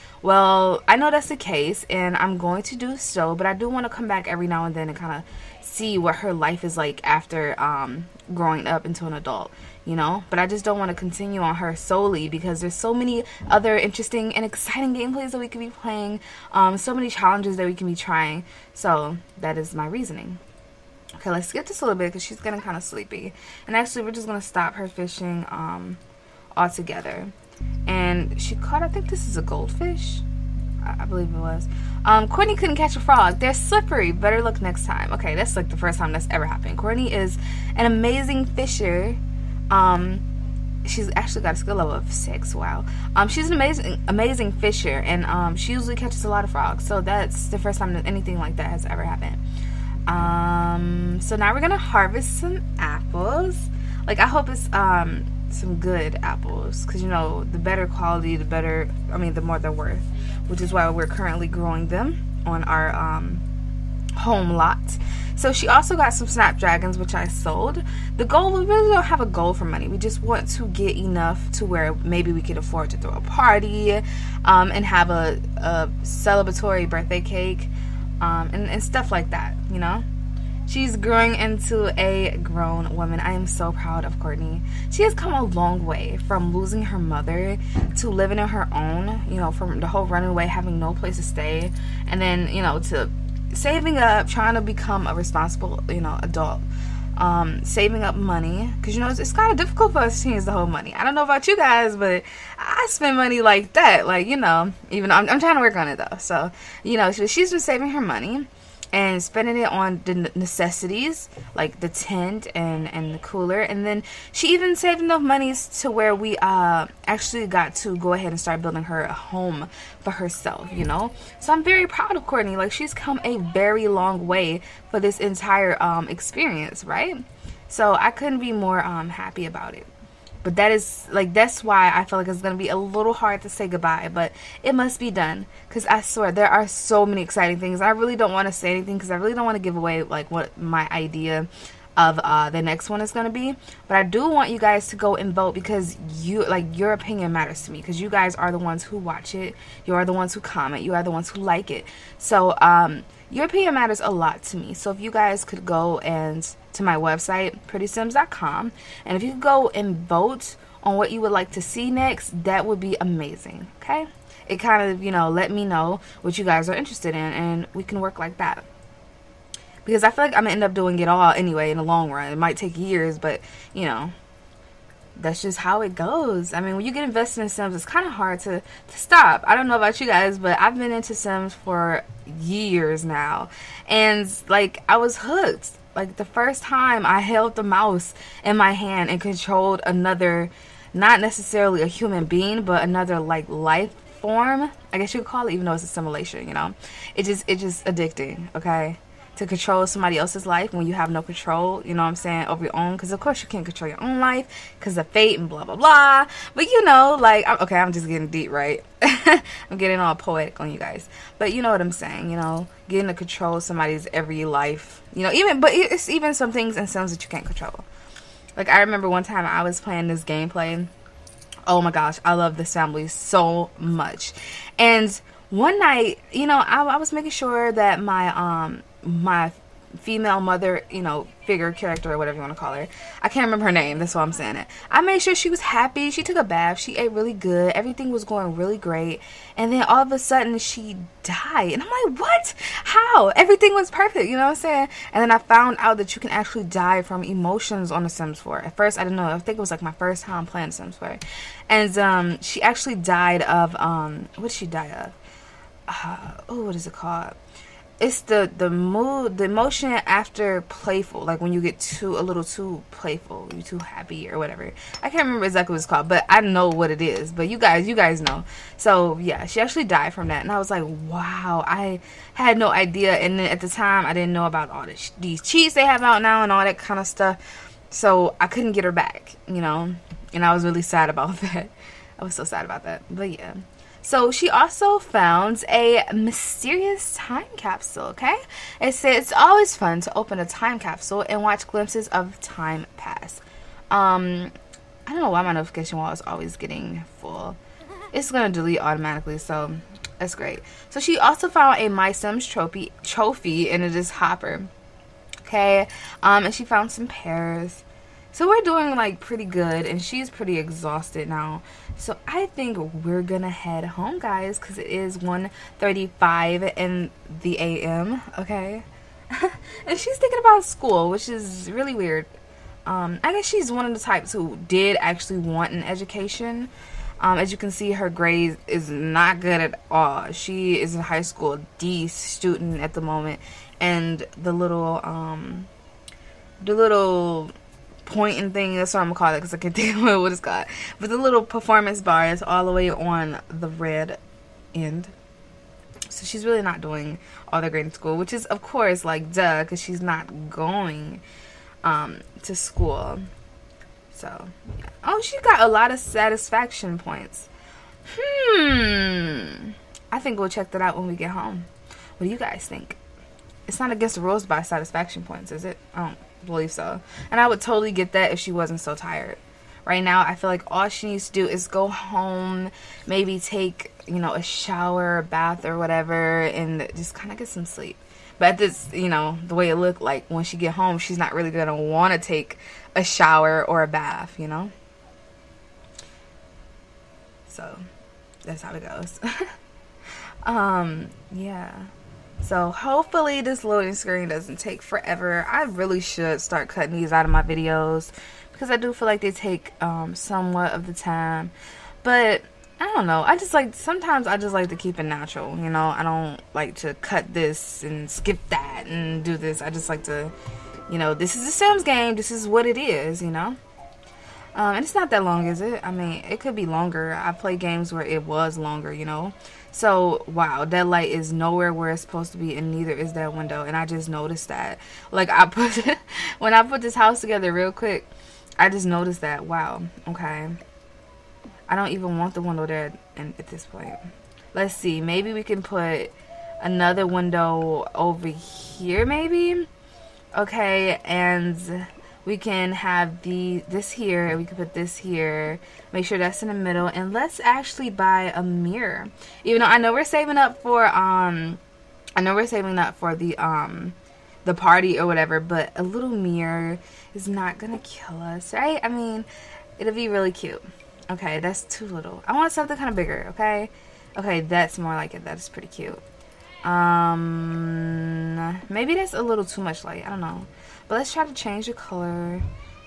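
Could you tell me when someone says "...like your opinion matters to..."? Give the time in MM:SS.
02:26.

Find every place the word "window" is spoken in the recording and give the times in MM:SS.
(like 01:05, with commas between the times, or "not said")
07:03, 07:12, 07:17.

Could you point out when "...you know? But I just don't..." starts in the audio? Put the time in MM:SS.
00:09.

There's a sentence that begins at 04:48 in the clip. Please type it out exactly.
It says it's always fun to open a time capsule and watch glimpses of time pass.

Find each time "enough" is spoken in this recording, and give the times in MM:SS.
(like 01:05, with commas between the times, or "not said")
01:10, 01:55.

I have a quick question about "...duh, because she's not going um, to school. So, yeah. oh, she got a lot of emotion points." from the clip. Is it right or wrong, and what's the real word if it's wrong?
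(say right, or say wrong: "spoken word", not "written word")
wrong: "satisfaction", not "emotion".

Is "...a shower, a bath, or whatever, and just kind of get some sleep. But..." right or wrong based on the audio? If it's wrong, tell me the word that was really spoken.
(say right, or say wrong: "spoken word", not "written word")
right.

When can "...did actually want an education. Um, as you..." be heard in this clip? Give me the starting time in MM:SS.
05:24.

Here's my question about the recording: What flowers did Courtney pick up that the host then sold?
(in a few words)
Snapdragons.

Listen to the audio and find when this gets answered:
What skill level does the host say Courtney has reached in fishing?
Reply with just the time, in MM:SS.
00:42.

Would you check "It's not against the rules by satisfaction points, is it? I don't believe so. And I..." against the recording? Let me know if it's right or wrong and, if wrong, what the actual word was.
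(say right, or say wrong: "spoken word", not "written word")
right.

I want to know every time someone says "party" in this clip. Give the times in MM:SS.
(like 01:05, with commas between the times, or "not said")
01:13, 07:34.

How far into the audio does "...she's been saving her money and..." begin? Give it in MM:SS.
01:47.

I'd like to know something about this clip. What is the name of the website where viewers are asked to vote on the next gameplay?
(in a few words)
prettiisims.com.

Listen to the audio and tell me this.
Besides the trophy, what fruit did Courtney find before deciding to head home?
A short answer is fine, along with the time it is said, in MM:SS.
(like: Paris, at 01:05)
Pears, at 05:07.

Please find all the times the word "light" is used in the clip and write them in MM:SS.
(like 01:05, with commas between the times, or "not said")
07:00, 07:49.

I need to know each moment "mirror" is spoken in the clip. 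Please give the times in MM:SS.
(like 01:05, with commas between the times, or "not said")
07:28, 07:36.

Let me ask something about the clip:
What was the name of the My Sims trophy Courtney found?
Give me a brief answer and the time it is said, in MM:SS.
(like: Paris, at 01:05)
Hopper, at 05:04.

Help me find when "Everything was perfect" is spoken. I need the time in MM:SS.
04:03.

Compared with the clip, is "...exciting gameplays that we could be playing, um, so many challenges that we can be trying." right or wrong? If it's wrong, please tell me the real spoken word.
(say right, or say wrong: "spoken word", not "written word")
right.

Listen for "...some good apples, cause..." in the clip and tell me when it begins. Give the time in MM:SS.
00:55.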